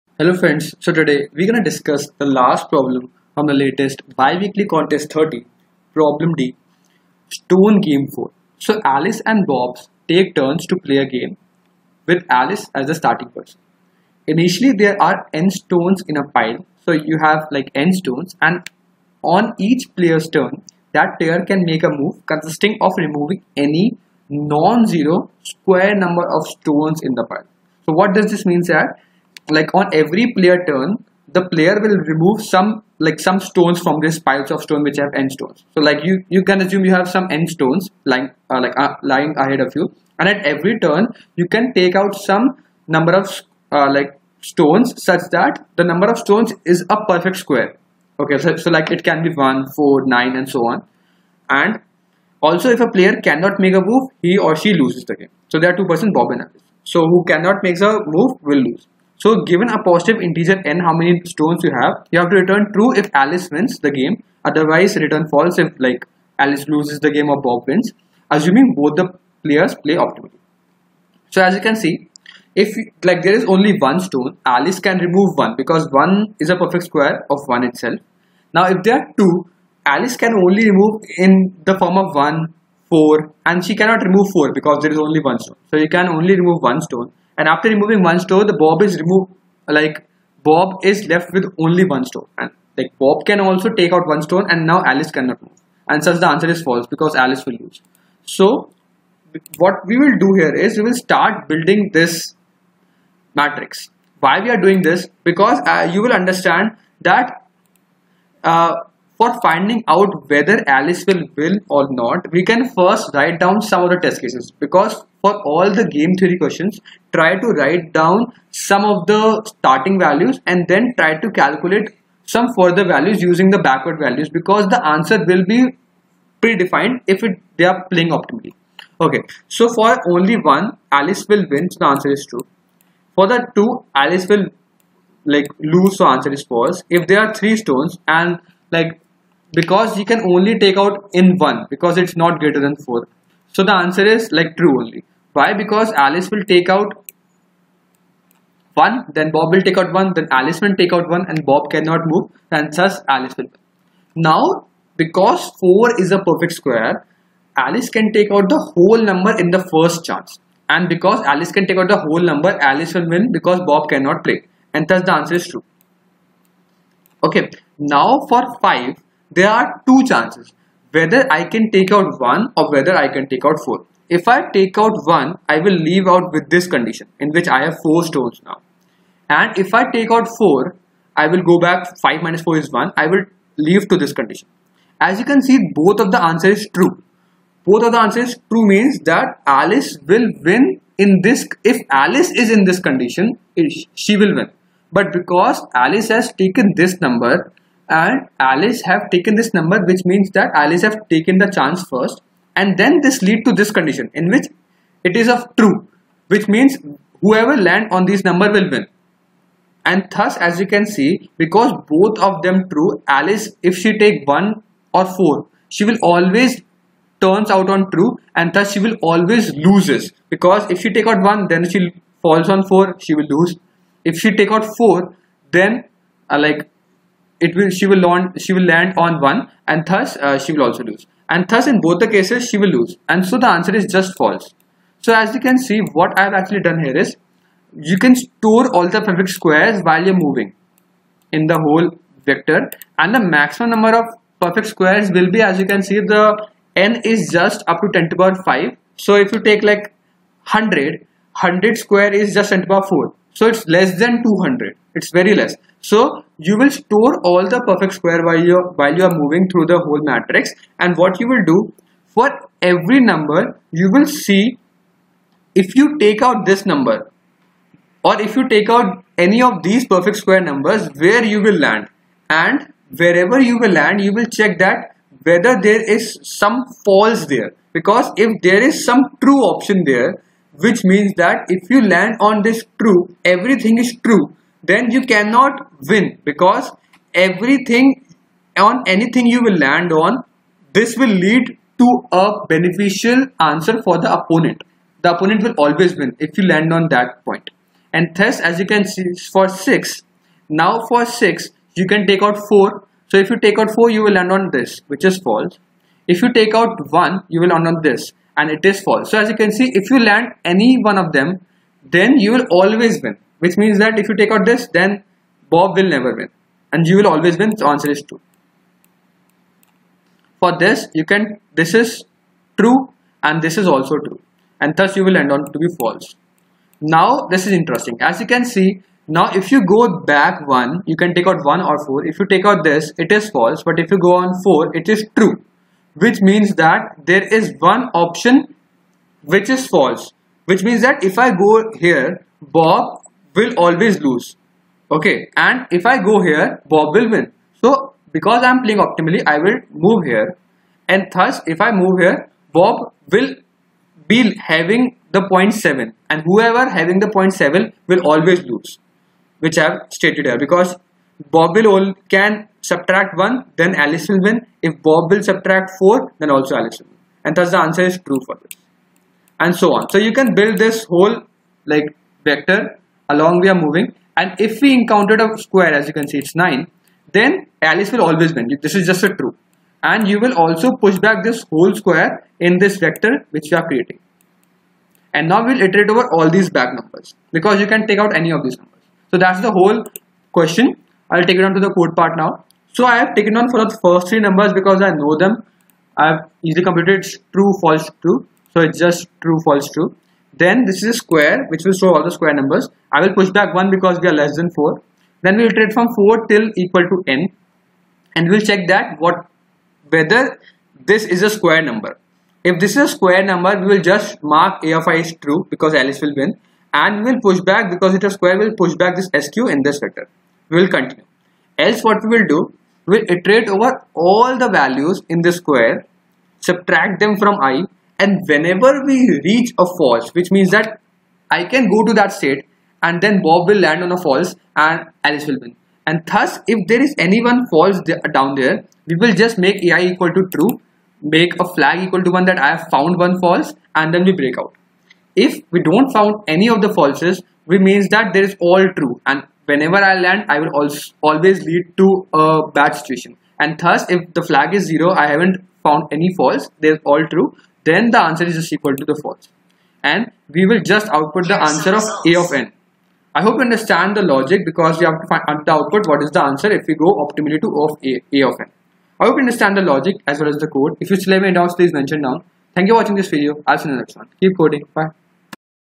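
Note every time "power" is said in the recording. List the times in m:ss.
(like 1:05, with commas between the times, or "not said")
4:08, 4:12.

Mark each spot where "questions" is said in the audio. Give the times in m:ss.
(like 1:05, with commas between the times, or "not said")
1:56, 6:30.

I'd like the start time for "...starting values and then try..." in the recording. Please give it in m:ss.
1:59.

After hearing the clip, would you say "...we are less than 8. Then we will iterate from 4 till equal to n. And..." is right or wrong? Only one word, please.
wrong.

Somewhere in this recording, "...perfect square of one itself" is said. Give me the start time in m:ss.
1:16.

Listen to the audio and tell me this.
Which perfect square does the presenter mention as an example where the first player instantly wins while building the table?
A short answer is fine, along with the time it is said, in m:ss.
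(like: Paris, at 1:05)
9, at 6:16.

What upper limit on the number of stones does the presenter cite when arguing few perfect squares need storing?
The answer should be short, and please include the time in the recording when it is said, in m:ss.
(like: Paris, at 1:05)
10^5, at 4:07.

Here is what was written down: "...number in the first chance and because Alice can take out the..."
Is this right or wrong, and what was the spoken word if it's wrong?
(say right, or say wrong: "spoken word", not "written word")
right.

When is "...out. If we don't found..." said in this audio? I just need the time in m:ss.
7:24.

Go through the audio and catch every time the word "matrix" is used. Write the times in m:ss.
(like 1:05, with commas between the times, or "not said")
1:43, 4:20.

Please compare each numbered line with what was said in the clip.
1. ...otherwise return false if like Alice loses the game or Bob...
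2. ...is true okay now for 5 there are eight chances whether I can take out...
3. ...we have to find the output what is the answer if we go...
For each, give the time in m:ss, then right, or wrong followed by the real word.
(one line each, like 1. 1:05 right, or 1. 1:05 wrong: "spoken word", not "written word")
1. 1:04 right
2. 2:45 wrong: "two", not "eight"
3. 7:44 right.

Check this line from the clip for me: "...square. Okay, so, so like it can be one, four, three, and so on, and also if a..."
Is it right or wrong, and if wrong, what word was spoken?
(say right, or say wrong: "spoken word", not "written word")
wrong: "nine", not "three".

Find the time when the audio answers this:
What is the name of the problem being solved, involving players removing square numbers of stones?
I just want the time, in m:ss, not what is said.
0:07.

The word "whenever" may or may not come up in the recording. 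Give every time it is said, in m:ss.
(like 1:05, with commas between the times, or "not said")
7:08, 7:29.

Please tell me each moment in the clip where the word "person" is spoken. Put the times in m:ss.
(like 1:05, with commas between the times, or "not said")
0:13, 0:55.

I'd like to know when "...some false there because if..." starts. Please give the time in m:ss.
4:36.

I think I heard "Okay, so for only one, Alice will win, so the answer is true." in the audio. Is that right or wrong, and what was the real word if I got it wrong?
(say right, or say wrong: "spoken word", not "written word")
right.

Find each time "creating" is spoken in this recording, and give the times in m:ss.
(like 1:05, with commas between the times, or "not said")
6:23.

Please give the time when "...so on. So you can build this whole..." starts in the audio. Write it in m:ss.
6:09.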